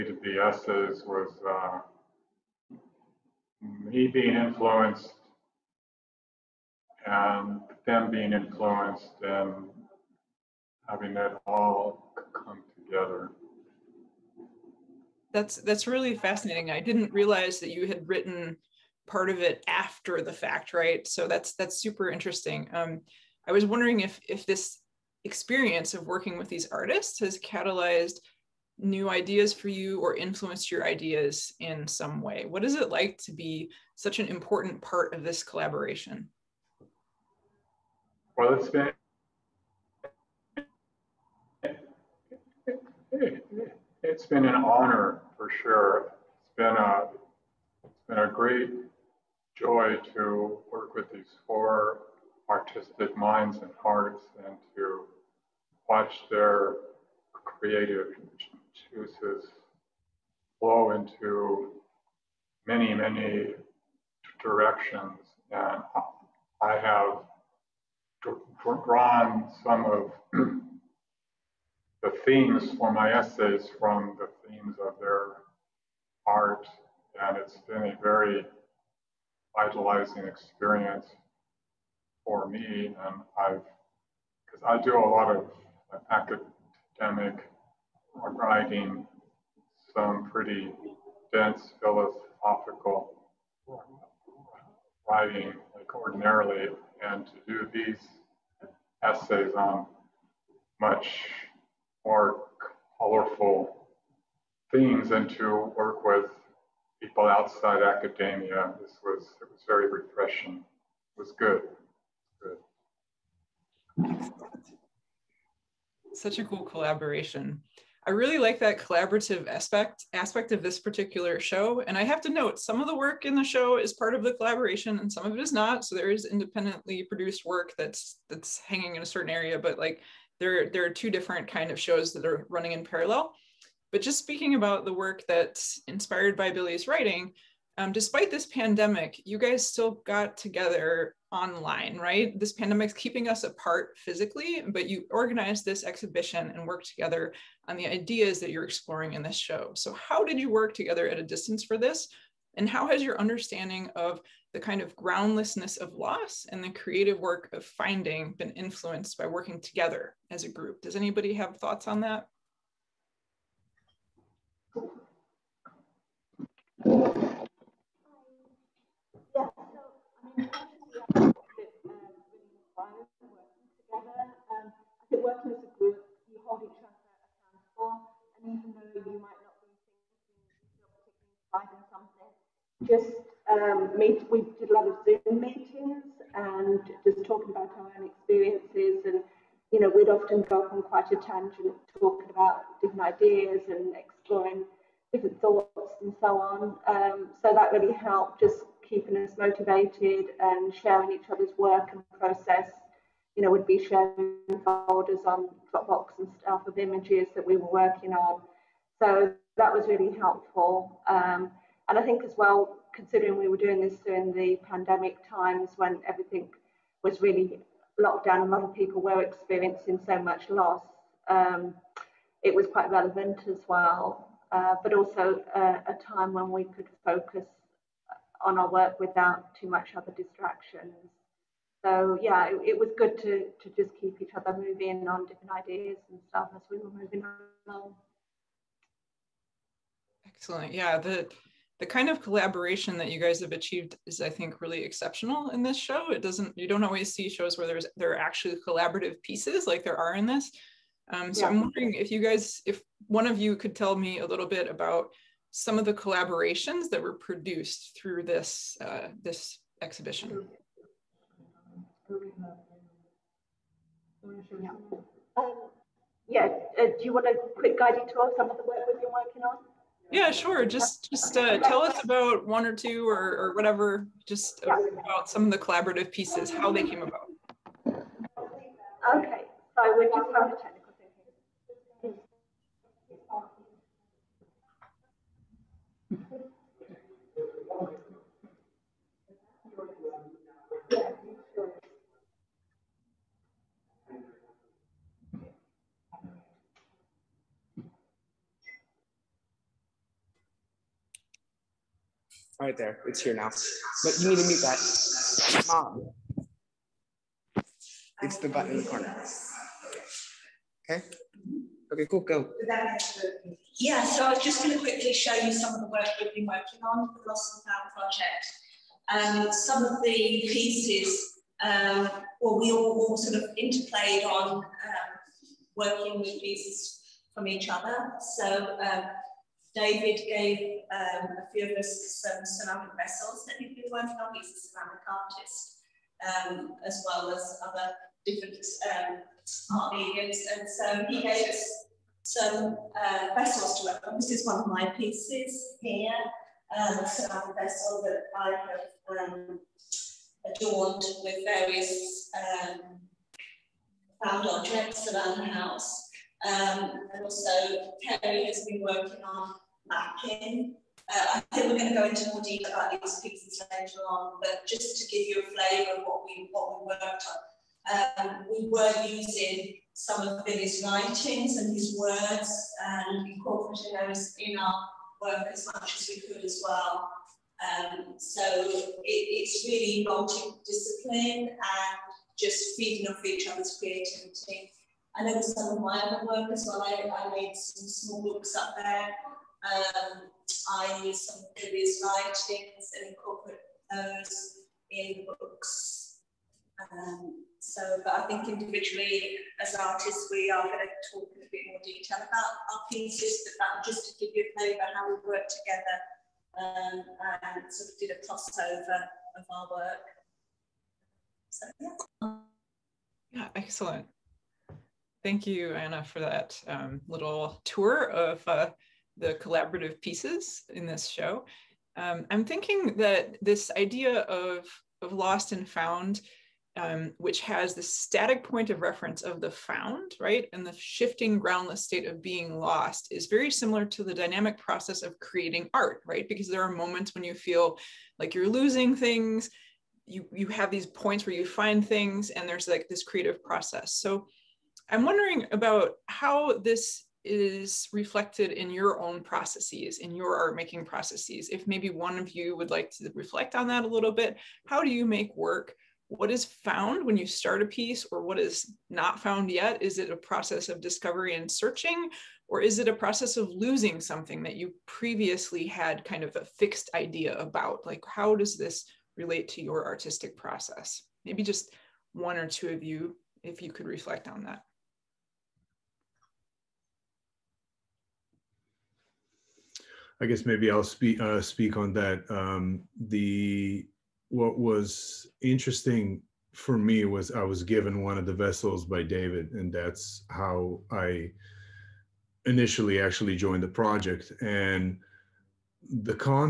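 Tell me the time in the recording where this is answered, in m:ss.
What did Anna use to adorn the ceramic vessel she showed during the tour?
5:54.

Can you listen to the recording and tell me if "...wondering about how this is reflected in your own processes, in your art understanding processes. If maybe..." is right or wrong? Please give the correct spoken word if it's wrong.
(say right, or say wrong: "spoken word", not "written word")
wrong: "making", not "understanding".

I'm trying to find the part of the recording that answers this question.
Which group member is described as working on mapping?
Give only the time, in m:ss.
5:58.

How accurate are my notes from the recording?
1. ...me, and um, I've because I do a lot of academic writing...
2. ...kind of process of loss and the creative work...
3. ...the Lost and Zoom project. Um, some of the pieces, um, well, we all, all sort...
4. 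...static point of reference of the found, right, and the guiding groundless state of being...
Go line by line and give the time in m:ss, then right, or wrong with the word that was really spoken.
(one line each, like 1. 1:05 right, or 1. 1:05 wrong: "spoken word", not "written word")
1. 1:22 right
2. 2:34 wrong: "groundlessness", not "process"
3. 5:17 wrong: "Found", not "Zoom"
4. 7:07 wrong: "shifting", not "guiding".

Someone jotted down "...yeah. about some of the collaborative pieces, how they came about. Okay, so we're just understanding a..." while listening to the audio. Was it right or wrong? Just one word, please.
wrong.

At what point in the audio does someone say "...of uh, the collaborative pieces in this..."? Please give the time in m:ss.
6:58.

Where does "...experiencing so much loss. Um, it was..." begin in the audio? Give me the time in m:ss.
3:39.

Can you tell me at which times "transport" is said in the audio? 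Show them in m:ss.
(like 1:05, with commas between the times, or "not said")
not said.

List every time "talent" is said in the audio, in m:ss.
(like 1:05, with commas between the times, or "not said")
not said.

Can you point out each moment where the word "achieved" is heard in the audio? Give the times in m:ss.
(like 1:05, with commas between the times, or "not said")
4:03.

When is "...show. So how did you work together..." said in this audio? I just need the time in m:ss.
2:29.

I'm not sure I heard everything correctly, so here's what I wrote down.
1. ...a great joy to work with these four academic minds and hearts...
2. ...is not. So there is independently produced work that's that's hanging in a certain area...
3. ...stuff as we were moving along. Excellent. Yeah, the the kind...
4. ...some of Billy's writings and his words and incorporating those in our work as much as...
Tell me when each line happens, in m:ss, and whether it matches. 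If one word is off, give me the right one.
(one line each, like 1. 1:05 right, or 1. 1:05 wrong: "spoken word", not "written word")
1. 0:48 wrong: "artistic", not "academic"
2. 2:05 right
3. 3:56 right
4. 6:09 right.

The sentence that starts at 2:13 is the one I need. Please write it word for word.
But just speaking about the work that's inspired by Billy's writing, um, despite this pandemic, you guys still got together online, right?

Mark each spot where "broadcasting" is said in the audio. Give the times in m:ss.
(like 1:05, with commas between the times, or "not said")
not said.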